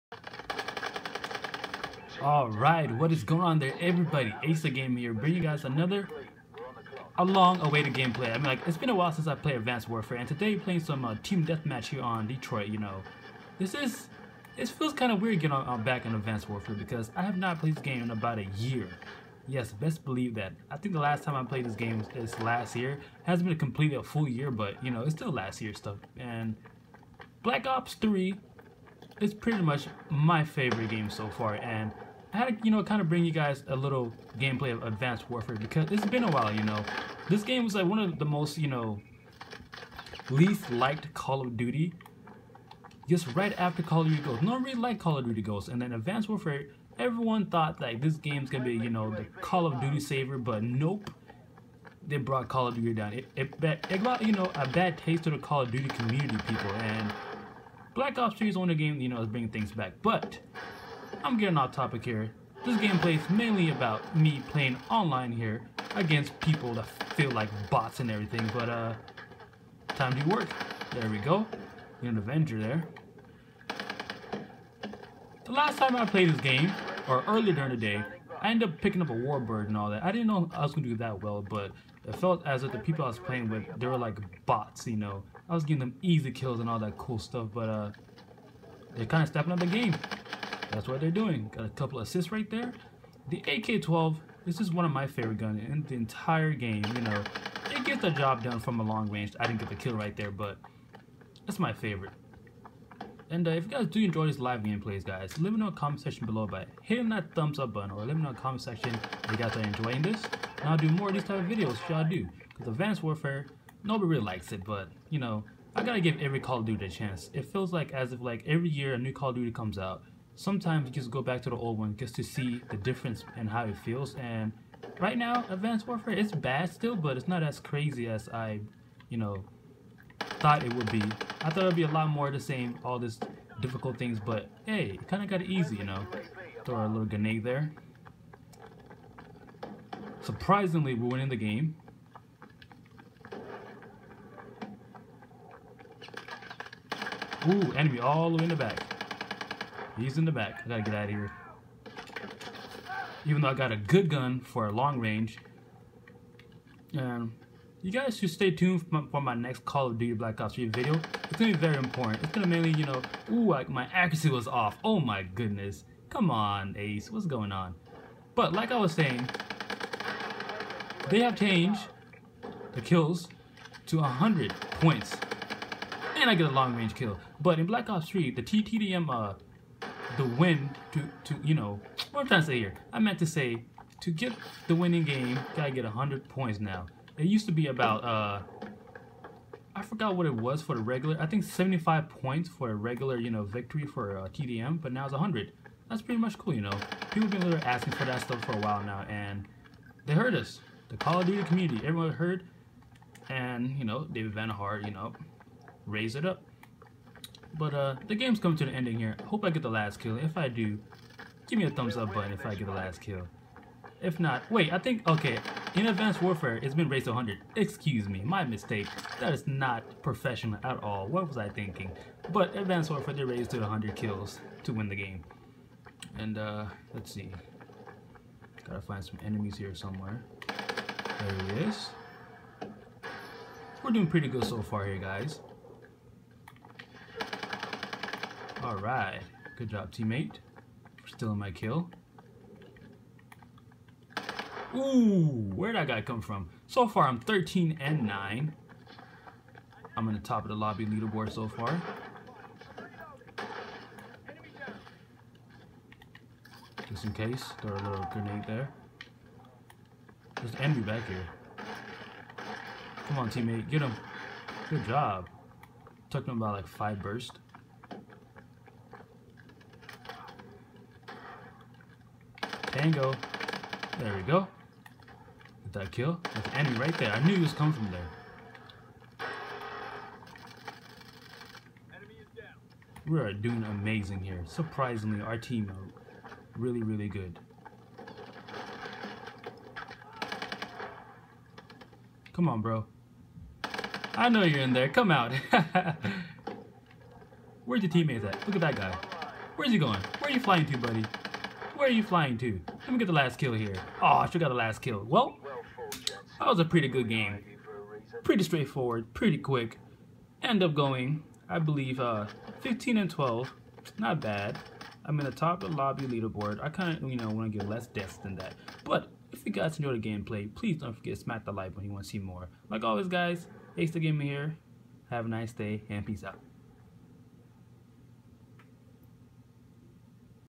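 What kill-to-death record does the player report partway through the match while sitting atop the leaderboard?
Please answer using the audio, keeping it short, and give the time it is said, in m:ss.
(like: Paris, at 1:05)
13 and 9, at 4:07.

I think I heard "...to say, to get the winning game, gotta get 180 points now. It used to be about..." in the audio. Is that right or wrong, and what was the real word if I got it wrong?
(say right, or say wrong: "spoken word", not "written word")
wrong: "100", not "180".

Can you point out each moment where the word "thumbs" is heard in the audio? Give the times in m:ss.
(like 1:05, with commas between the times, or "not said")
1:47, 3:31.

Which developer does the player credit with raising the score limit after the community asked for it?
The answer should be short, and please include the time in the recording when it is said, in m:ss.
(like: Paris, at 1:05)
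David Vonderhaar, at 3:24.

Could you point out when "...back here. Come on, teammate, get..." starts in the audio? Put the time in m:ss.
4:20.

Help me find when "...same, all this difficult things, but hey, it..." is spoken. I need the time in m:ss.
2:12.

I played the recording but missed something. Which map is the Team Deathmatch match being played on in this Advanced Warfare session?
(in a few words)
Detroit.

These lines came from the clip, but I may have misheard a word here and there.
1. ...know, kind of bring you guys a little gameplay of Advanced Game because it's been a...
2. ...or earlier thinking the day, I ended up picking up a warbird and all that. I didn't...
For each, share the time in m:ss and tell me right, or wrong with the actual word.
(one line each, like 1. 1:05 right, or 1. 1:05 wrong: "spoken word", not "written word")
1. 0:32 wrong: "Warfare", not "Game"
2. 1:17 wrong: "during", not "thinking".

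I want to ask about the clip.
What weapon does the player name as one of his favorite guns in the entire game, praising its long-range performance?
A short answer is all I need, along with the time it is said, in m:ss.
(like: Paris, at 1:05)
AK-12, at 1:33.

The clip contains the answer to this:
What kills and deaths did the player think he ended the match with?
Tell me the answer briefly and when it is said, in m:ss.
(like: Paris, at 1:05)
15 and 12, at 5:12.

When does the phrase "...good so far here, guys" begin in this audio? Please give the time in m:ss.
3:54.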